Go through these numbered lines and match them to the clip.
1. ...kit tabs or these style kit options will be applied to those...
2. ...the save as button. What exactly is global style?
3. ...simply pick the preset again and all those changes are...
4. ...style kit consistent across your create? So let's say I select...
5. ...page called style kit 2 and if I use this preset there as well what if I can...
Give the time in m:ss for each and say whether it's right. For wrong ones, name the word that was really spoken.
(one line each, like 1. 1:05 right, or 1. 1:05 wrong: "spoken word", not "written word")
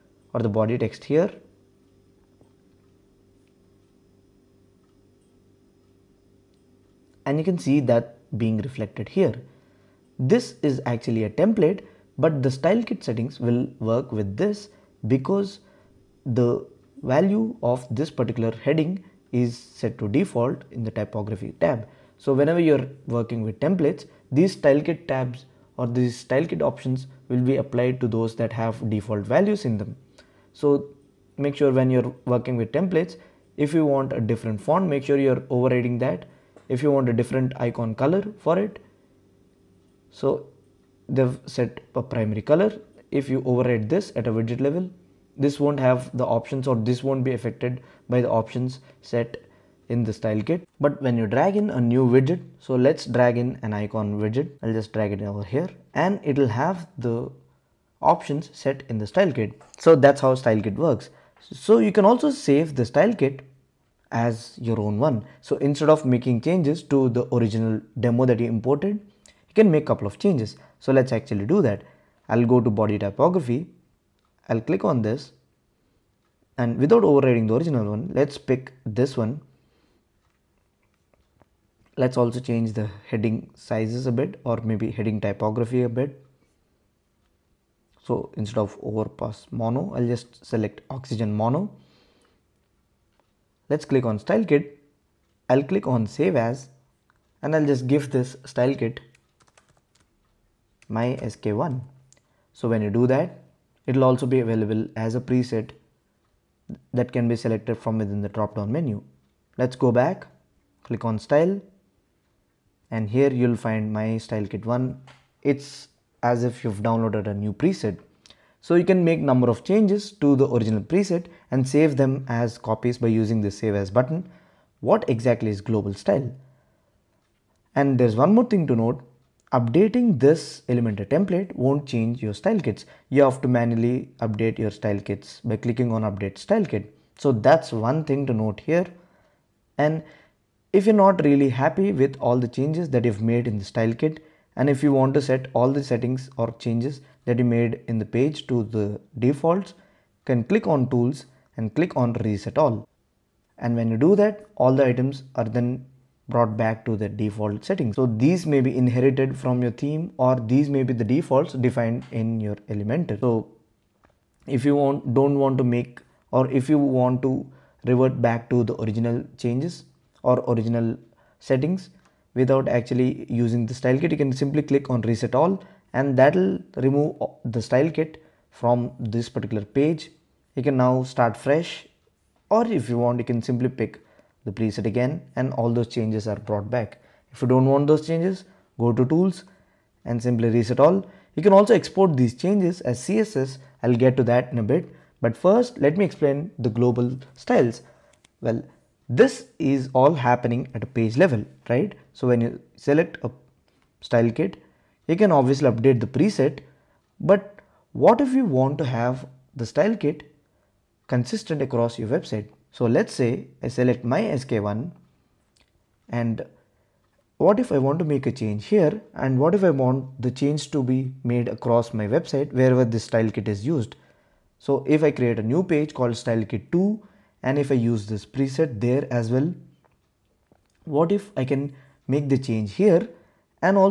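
1. 0:24 right
2. 2:03 right
3. 3:03 right
4. 3:29 wrong: "website", not "create"
5. 3:45 right.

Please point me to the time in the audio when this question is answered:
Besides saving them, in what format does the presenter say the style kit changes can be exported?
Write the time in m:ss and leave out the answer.
3:13.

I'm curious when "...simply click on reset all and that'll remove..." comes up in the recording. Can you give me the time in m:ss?
2:54.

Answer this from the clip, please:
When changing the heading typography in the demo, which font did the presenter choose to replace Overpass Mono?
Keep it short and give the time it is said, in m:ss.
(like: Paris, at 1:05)
Oxygen Mono, at 1:30.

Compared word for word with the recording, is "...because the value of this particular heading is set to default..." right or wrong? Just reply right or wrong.
right.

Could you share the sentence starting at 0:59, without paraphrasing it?
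So that's how style kit works.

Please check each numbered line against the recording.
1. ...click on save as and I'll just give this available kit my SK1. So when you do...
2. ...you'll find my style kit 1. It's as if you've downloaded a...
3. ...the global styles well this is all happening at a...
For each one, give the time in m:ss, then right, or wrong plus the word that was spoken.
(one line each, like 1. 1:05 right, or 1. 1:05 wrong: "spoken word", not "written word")
1. 1:35 wrong: "style", not "available"
2. 1:53 right
3. 3:16 right.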